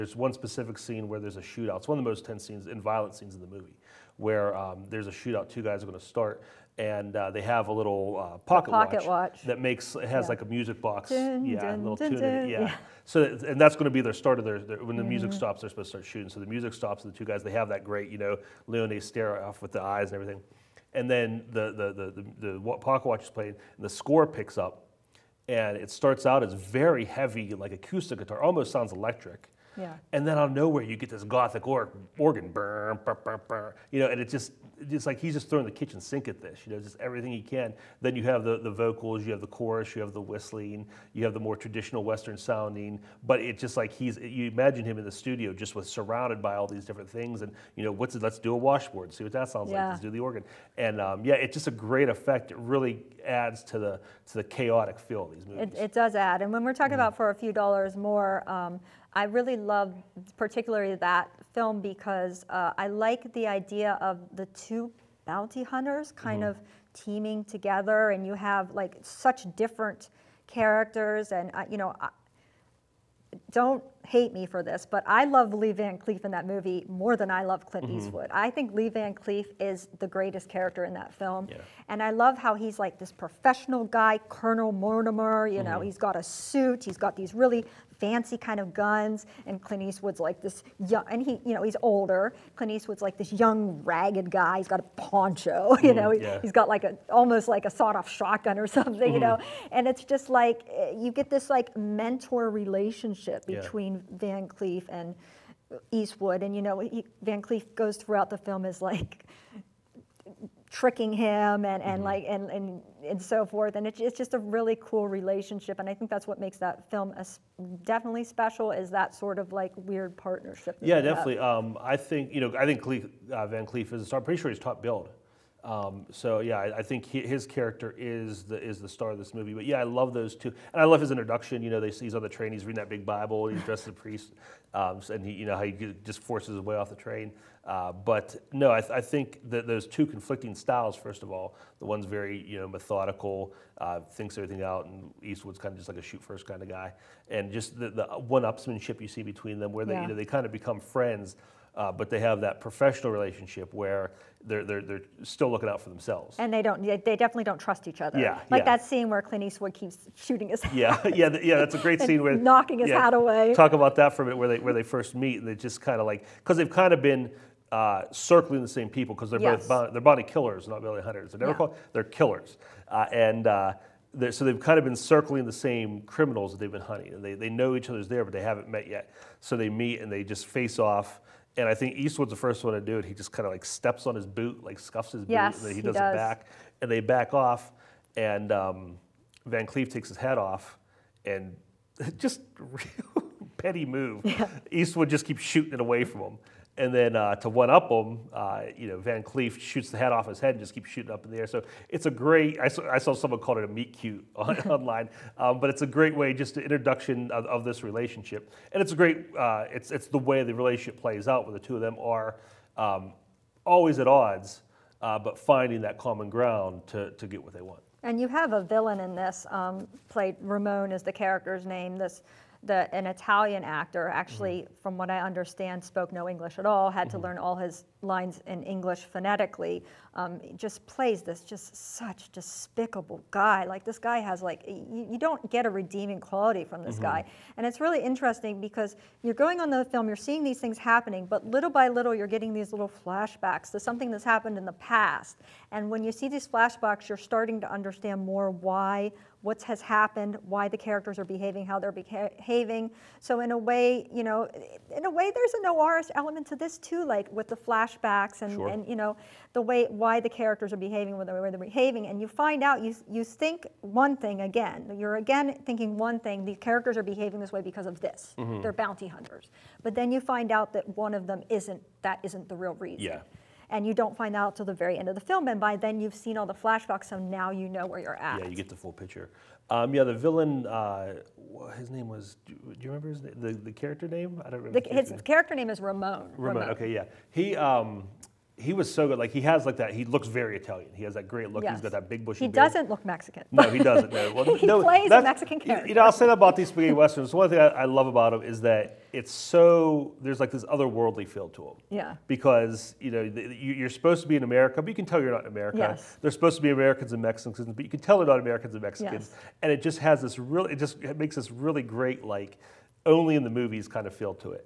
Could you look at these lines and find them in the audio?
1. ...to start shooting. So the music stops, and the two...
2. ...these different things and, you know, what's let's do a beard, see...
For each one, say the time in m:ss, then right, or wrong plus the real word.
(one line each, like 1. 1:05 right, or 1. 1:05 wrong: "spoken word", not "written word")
1. 0:15 right
2. 0:46 wrong: "washboard", not "beard".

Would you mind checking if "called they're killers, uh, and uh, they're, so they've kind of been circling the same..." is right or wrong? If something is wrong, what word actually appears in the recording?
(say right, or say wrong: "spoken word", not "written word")
right.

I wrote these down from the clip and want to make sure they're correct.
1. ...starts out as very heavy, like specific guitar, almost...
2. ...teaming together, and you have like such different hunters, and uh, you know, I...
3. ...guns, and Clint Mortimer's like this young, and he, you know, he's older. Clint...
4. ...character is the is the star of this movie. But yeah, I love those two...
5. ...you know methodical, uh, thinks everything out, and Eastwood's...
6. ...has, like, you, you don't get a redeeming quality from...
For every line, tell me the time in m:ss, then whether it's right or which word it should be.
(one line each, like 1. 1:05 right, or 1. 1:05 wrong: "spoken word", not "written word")
1. 0:25 wrong: "acoustic", not "specific"
2. 1:06 wrong: "characters", not "hunters"
3. 1:28 wrong: "Eastwood", not "Mortimer"
4. 2:07 right
5. 2:22 right
6. 3:54 right.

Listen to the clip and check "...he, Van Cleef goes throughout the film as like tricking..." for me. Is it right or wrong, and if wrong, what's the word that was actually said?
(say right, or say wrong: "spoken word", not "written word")
right.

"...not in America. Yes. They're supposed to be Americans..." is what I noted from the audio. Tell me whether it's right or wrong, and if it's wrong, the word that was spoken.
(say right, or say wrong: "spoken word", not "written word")
right.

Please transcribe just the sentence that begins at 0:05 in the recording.
Two guys are going to start, and uh, they have a little uh, pocket, pocket watch, watch, that makes it has yeah.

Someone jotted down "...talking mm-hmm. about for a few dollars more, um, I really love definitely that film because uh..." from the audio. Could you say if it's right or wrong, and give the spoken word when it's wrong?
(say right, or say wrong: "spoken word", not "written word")
wrong: "particularly", not "definitely".